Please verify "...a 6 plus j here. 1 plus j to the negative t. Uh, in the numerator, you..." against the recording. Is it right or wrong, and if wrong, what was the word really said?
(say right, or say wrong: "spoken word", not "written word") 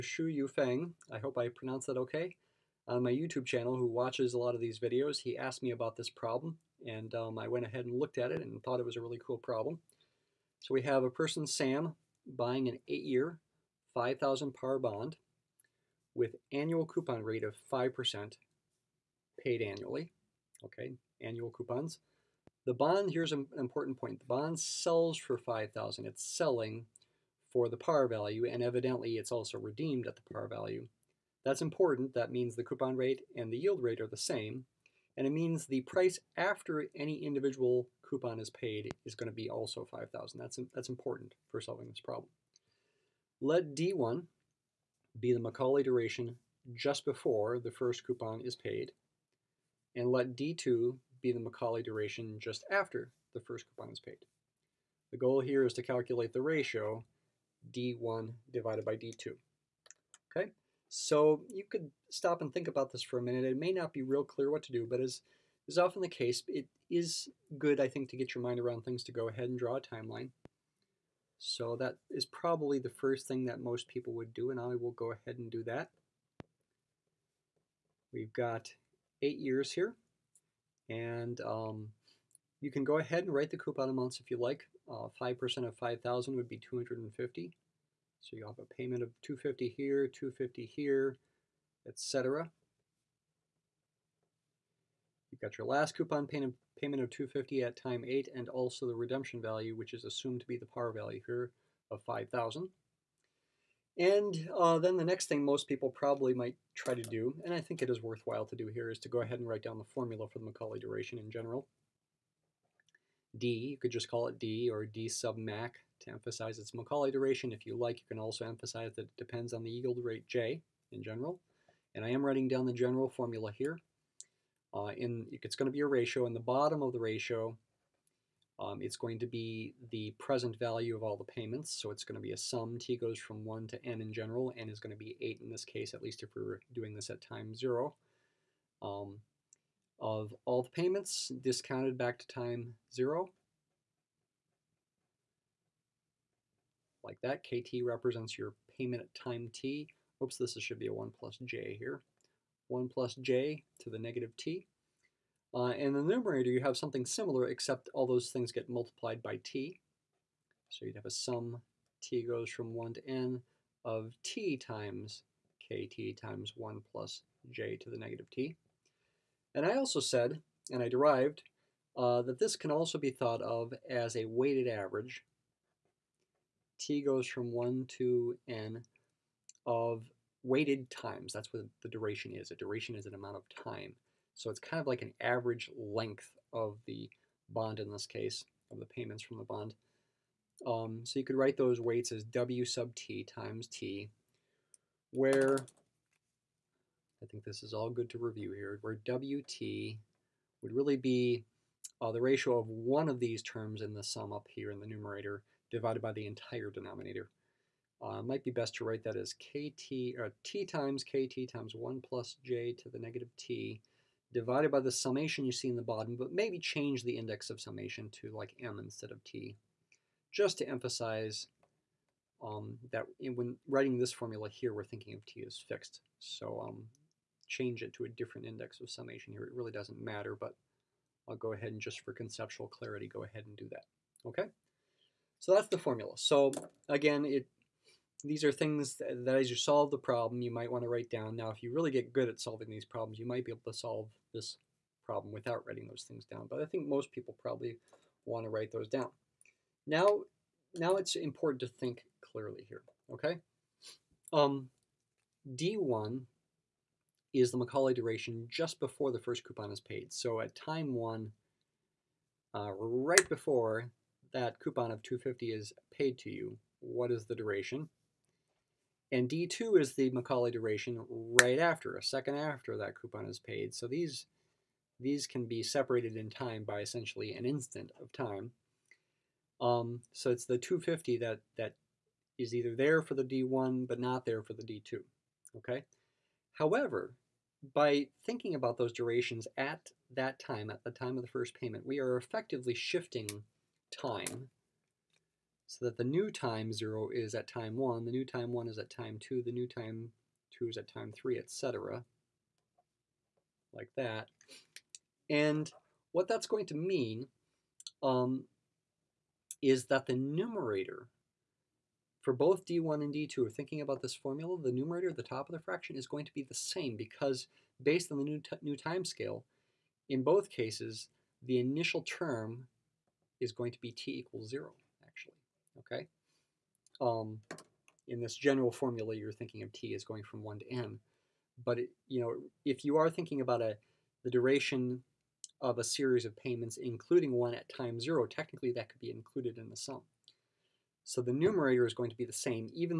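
wrong: "1", not "6".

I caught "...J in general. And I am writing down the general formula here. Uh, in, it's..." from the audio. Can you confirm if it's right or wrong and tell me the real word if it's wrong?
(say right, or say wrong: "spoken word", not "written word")
right.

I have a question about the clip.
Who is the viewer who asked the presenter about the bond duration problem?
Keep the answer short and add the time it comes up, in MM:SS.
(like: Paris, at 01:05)
Yufeng, at 00:00.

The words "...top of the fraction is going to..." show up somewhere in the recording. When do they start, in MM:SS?
05:15.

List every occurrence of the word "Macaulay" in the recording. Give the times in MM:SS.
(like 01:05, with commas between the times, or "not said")
00:45, 00:51, 01:50, 01:56, 04:17, 04:30.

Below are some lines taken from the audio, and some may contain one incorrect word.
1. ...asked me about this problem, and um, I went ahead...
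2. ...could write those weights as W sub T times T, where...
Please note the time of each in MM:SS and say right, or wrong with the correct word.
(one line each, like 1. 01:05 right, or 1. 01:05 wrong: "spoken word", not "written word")
1. 00:05 right
2. 03:11 right.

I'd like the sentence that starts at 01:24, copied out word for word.
5% uh, of 5,000 would be 250.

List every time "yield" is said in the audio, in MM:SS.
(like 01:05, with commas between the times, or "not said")
00:33, 01:59.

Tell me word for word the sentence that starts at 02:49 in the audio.
And I also said, and I derived, uh, that this can also be thought of as a weighted average.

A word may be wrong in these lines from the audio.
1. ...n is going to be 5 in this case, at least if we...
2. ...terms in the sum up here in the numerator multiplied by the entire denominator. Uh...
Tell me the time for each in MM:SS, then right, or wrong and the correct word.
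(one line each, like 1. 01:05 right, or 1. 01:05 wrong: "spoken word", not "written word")
1. 02:14 wrong: "8", not "5"
2. 03:23 wrong: "divided", not "multiplied".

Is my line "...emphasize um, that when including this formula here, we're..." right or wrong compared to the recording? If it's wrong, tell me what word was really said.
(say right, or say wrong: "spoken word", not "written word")
wrong: "writing", not "including".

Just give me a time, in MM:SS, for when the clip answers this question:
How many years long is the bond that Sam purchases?
00:12.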